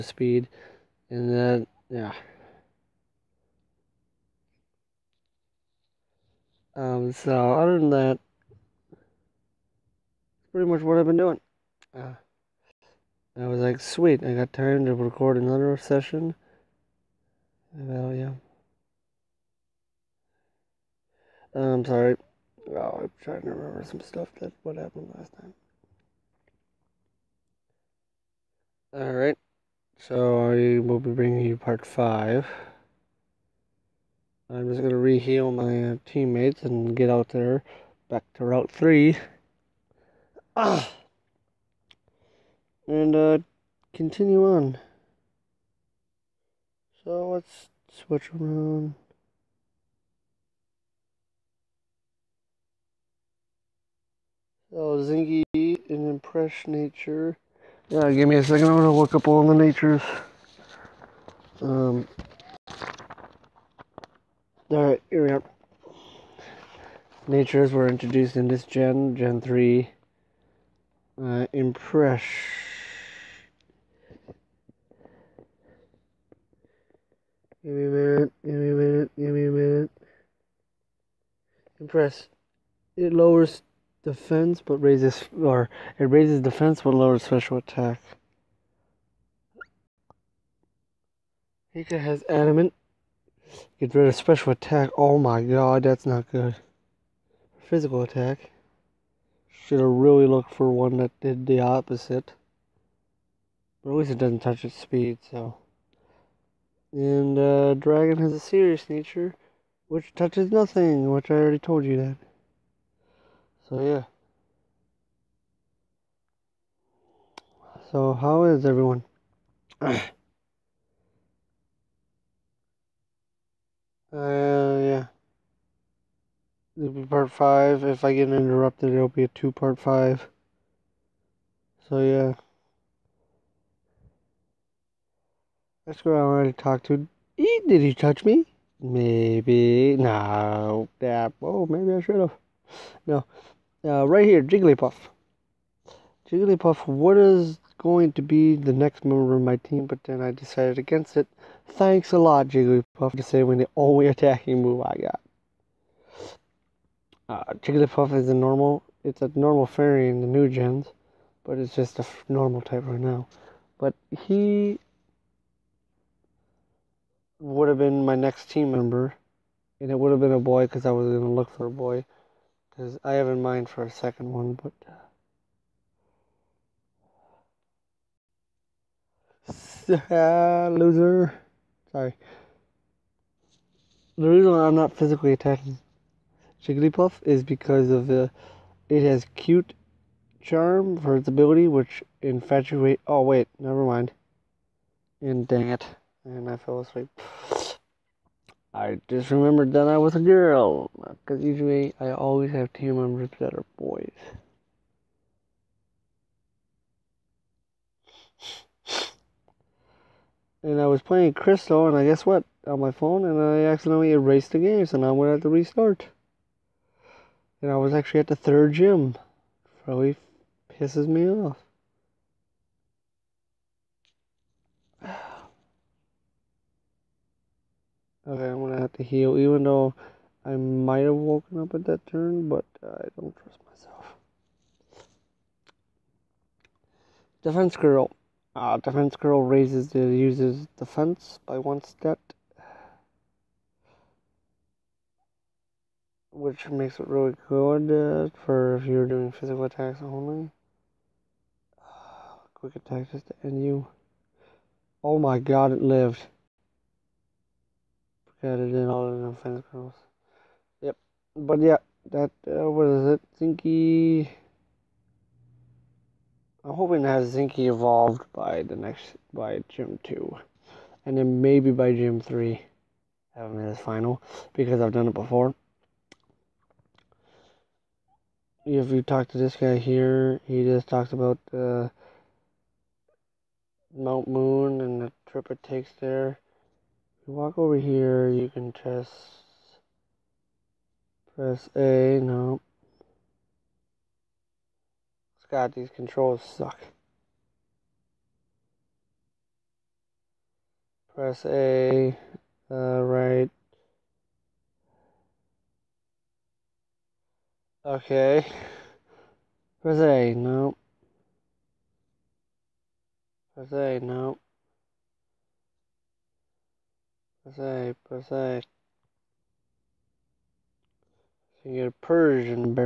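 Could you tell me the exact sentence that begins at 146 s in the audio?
Jigglypuff, what is going to be the next member of my team, but then I decided against it.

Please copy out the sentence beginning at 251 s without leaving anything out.
Uh, quick attack just to end you.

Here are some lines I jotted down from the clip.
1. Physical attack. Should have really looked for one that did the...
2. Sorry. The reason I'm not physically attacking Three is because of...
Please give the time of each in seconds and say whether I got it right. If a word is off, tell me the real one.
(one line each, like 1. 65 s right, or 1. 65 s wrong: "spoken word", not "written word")
1. 97 s right
2. 181 s wrong: "Jigglypuff", not "Three".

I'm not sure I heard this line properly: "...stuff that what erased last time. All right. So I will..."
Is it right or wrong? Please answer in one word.
wrong.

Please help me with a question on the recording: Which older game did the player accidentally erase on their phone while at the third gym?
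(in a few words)
Crystal.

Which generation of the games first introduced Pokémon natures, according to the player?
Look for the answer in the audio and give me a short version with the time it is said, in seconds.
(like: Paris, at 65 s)
Gen 3, at 69 s.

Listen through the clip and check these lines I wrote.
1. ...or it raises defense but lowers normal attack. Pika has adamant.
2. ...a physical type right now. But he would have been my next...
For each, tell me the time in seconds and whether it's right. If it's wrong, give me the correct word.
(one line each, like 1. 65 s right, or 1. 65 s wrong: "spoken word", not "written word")
1. 85 s wrong: "special", not "normal"
2. 161 s wrong: "normal", not "physical".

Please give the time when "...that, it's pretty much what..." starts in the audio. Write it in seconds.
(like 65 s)
7 s.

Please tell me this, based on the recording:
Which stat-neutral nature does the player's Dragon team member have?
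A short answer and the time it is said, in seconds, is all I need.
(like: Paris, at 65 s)
Serious, at 108 s.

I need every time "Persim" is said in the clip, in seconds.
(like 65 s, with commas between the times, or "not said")
322 s.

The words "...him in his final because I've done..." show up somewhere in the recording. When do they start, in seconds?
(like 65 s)
273 s.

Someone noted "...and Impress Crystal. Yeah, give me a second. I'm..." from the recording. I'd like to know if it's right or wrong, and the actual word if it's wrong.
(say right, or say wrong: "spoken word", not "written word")
wrong: "Nature", not "Crystal".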